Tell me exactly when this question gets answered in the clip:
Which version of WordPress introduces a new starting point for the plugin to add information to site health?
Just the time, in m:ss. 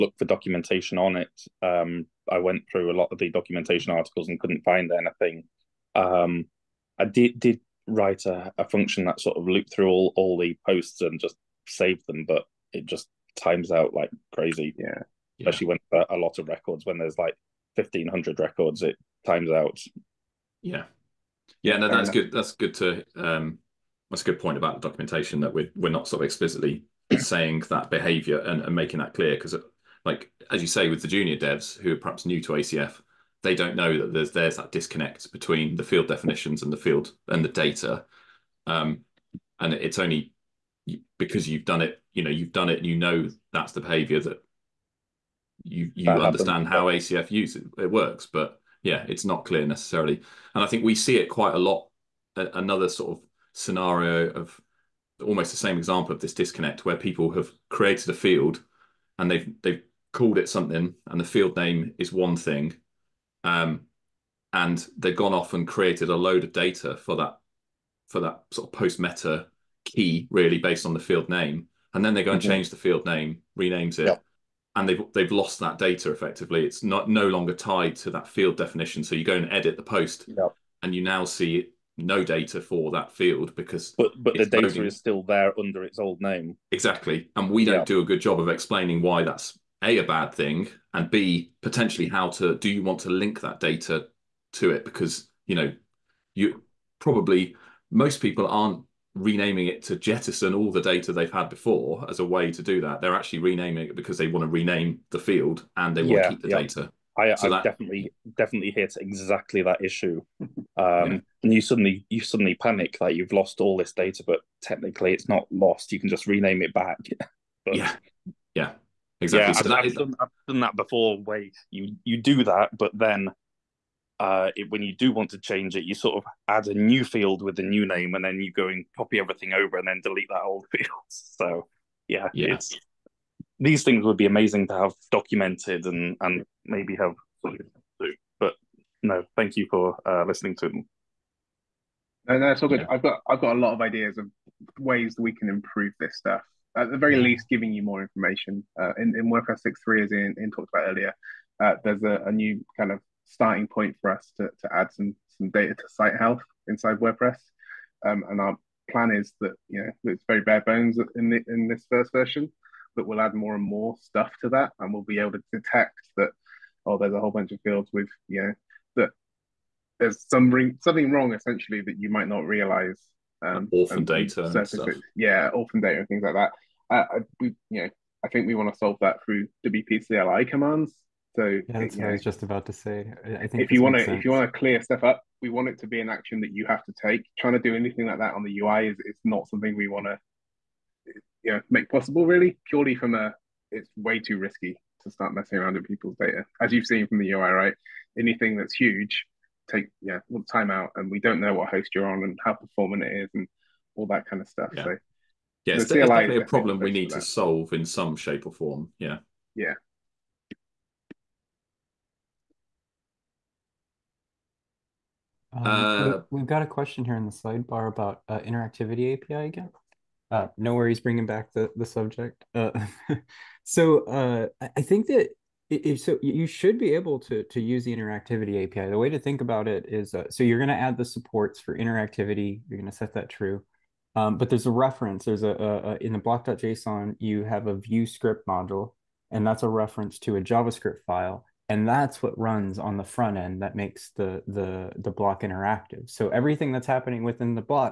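2:29.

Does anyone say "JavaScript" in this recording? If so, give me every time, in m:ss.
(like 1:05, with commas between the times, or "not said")
4:00.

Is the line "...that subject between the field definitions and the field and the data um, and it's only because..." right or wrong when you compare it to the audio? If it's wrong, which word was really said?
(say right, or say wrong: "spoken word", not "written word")
wrong: "disconnect", not "subject".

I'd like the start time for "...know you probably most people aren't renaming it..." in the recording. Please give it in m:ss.
1:35.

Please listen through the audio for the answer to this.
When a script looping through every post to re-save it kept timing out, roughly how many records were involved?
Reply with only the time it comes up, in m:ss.
0:17.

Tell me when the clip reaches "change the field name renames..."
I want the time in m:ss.
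1:12.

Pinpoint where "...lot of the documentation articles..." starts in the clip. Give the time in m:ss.
0:02.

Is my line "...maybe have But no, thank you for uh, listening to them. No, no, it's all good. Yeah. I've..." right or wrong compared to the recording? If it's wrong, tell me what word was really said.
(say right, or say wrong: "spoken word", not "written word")
right.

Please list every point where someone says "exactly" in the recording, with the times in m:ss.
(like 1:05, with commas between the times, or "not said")
1:26, 1:49, 1:59.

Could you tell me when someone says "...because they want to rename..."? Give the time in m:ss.
1:43.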